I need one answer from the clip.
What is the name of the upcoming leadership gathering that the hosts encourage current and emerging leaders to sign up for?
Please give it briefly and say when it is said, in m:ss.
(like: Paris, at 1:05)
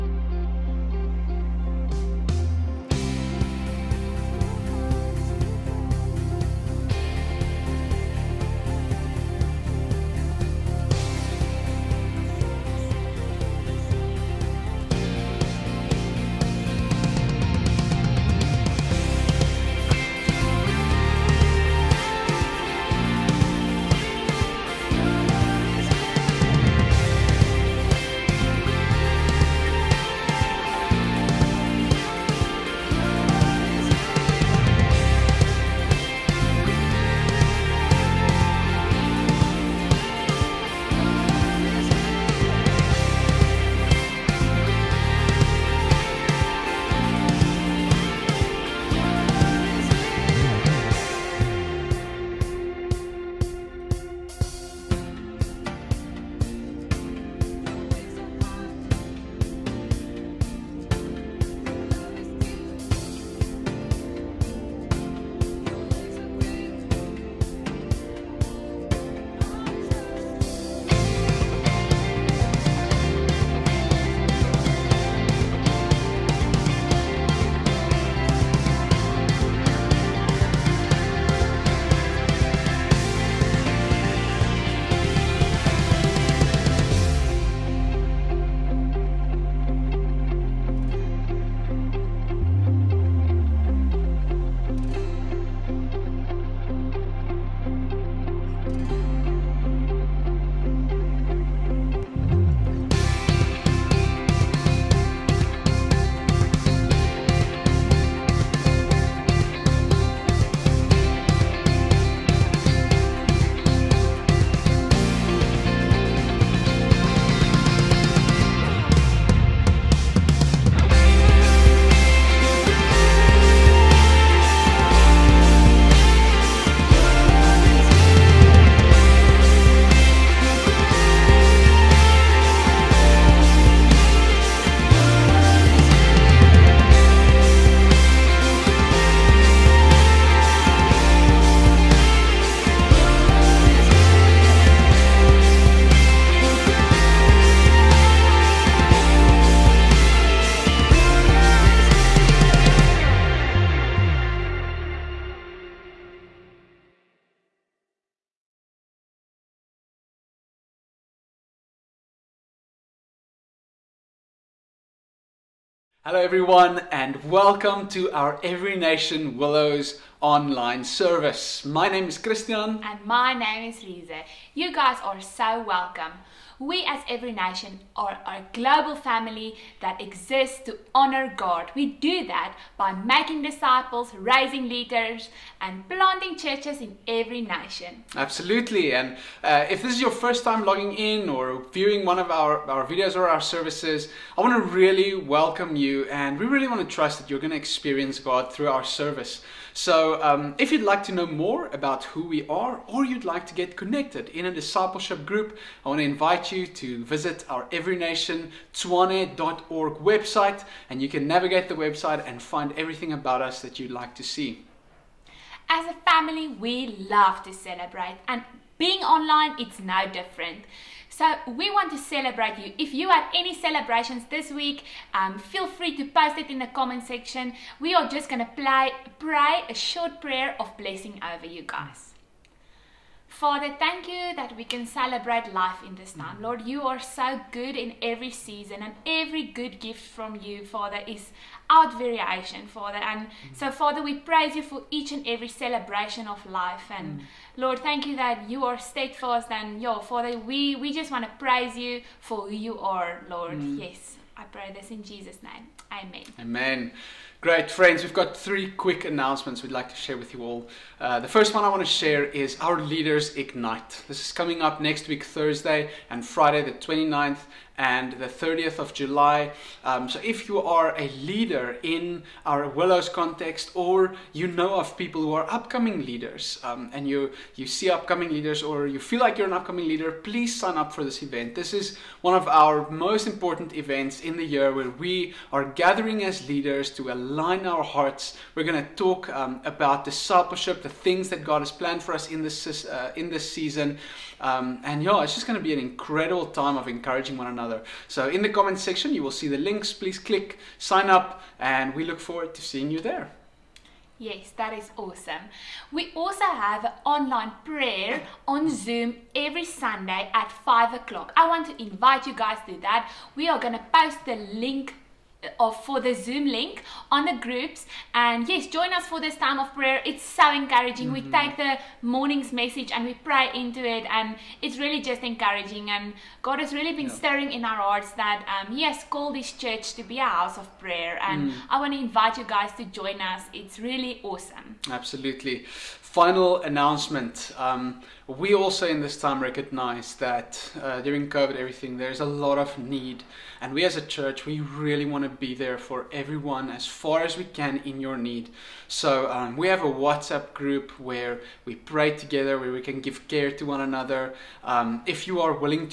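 Leaders Ignite, at 4:22.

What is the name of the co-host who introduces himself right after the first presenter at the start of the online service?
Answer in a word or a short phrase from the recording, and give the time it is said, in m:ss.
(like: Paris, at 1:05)
Rize, at 2:53.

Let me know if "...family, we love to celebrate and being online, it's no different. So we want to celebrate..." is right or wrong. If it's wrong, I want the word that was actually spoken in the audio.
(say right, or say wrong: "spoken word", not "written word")
right.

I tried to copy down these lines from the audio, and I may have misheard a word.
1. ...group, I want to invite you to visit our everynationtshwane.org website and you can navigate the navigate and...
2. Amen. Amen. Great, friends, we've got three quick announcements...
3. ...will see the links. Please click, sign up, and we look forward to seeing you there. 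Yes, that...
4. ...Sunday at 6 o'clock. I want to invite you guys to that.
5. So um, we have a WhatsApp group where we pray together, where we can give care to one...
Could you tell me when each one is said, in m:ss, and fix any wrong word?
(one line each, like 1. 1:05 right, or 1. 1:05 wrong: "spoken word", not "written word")
1. 3:25 wrong: "website", not "navigate"
2. 4:15 right
3. 4:59 right
4. 5:09 wrong: "5", not "6"
5. 5:48 right.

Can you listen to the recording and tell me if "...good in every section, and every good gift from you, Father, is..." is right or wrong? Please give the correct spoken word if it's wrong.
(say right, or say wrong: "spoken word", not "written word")
wrong: "season", not "section".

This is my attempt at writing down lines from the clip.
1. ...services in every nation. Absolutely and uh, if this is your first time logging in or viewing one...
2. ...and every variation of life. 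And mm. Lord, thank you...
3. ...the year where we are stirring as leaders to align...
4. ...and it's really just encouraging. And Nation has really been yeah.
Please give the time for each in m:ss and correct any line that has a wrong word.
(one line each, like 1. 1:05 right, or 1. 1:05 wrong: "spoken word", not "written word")
1. 3:06 wrong: "churches", not "services"
2. 4:05 wrong: "celebration", not "variation"
3. 4:44 wrong: "gathering", not "stirring"
4. 5:24 wrong: "God", not "Nation".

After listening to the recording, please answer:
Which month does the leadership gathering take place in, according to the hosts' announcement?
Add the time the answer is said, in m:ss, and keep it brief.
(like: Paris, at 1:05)
July, at 4:28.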